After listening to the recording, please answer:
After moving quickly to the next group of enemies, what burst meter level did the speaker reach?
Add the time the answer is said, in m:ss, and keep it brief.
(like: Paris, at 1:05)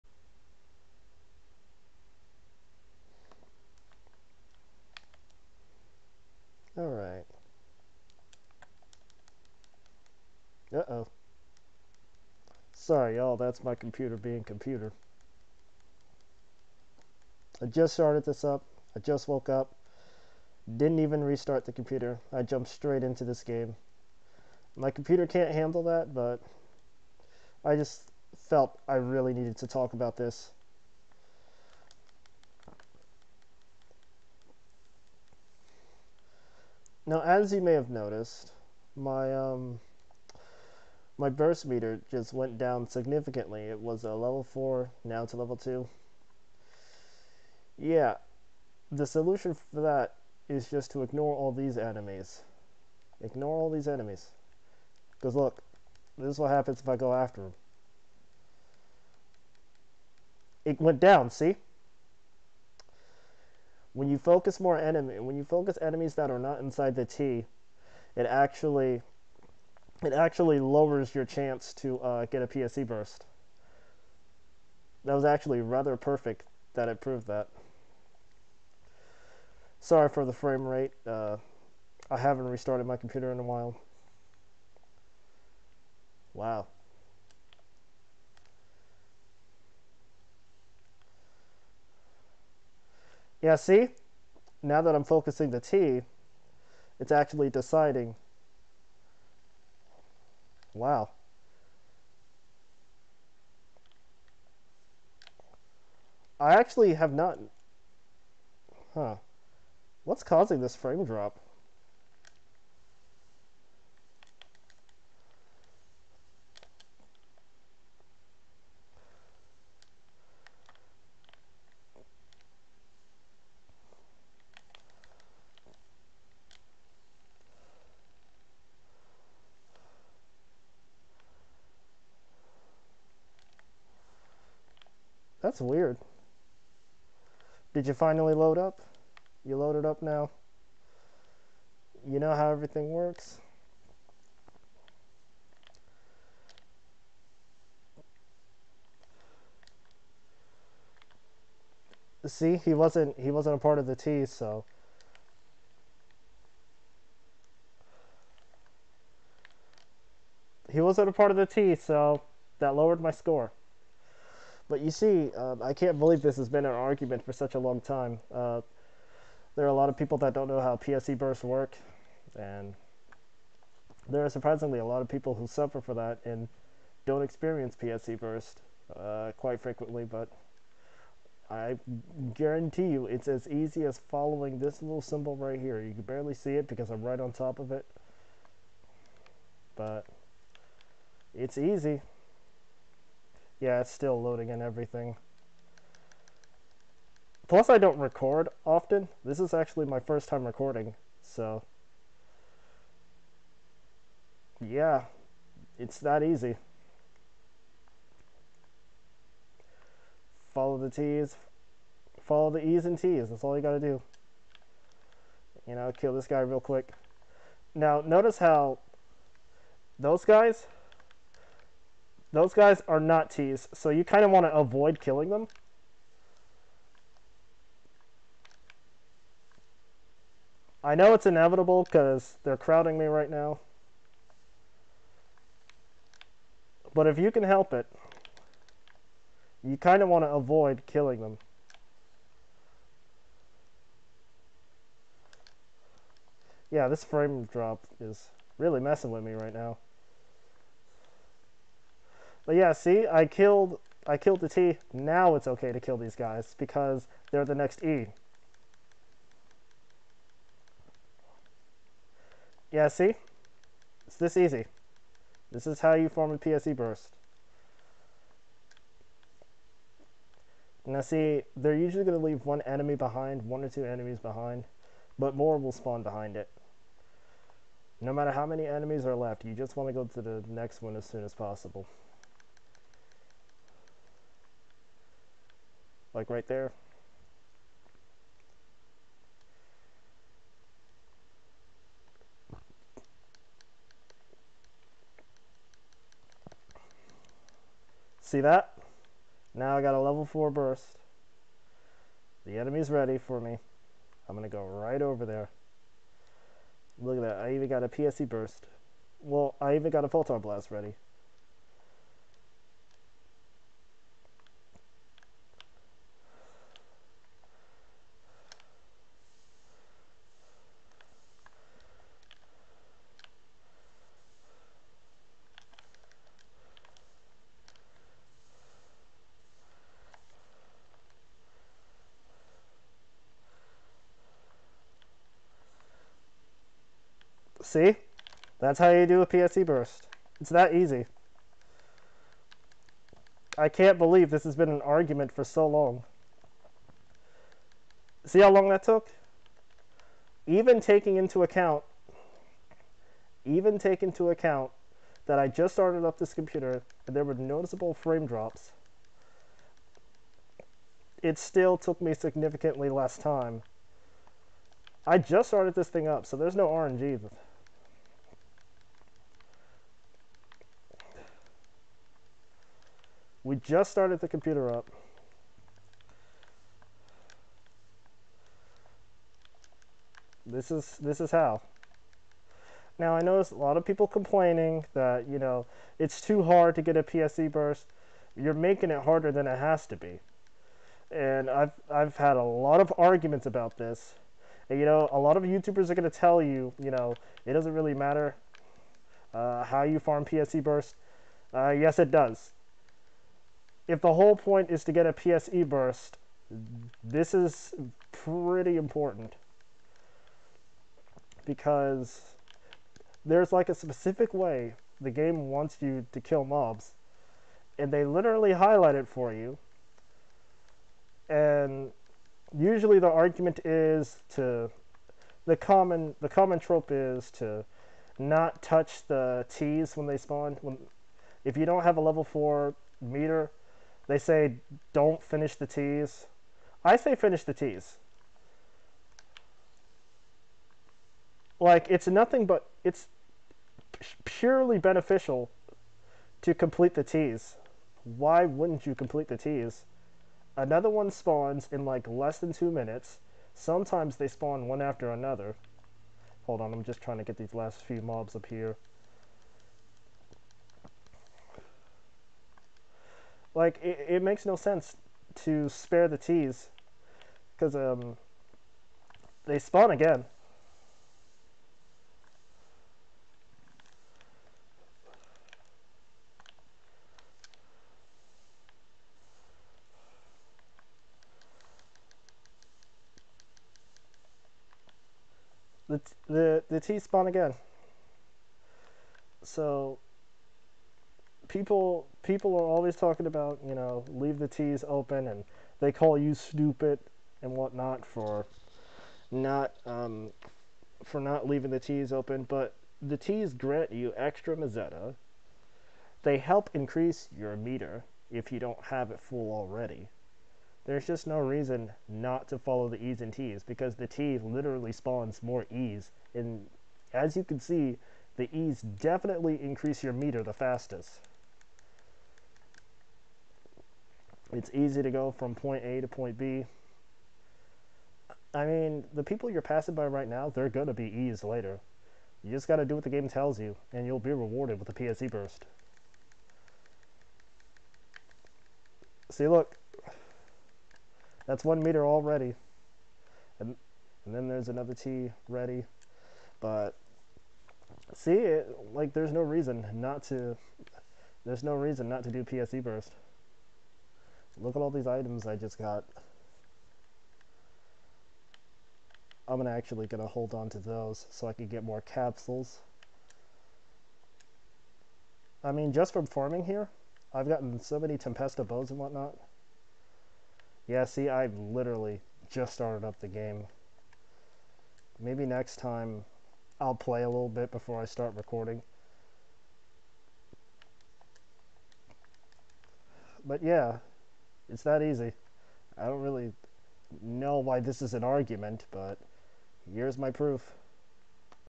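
level 4, at 4:59.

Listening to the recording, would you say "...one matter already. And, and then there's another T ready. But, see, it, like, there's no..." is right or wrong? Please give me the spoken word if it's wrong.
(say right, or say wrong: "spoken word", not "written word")
wrong: "meter", not "matter".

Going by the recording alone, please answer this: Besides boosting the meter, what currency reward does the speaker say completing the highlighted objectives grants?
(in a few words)
meseta.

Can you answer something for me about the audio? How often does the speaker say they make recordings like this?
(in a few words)
first time recording.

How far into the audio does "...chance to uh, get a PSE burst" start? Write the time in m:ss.
1:11.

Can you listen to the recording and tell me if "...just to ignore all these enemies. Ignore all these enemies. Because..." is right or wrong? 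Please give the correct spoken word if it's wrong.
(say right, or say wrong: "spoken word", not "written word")
right.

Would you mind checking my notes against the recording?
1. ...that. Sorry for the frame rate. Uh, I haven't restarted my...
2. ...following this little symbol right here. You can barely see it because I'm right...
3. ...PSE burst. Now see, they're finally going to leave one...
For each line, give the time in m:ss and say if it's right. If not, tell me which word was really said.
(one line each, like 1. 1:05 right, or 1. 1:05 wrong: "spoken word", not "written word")
1. 1:17 right
2. 3:04 right
3. 4:26 wrong: "usually", not "finally".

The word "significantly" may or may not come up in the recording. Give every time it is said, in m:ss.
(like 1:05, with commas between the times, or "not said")
0:42, 6:02.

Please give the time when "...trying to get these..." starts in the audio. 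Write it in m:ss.
7:36.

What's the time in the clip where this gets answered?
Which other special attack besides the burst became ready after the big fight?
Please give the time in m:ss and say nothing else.
5:10.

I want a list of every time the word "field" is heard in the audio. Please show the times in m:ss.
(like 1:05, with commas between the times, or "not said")
not said.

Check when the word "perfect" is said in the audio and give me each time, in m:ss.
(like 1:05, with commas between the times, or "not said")
1:15.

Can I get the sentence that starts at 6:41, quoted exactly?
Uh, yes, it does if the whole point is to get a PSE burst, this is pretty important.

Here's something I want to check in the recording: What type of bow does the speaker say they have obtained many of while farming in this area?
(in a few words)
Tempesta bows.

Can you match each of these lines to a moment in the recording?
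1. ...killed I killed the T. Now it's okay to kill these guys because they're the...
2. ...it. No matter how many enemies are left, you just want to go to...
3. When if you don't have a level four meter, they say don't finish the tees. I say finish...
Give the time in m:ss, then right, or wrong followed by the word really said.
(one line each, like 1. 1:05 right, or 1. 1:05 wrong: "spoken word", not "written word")
1. 4:13 right
2. 4:36 right
3. 7:10 right.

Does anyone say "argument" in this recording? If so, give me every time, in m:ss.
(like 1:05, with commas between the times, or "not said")
2:46, 5:44, 6:32, 7:03, 9:48.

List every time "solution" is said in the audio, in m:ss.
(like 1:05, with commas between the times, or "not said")
0:49.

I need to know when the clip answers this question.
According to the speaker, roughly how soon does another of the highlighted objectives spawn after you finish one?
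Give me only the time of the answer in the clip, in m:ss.
7:32.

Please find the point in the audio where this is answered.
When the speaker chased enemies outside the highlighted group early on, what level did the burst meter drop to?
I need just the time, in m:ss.
0:45.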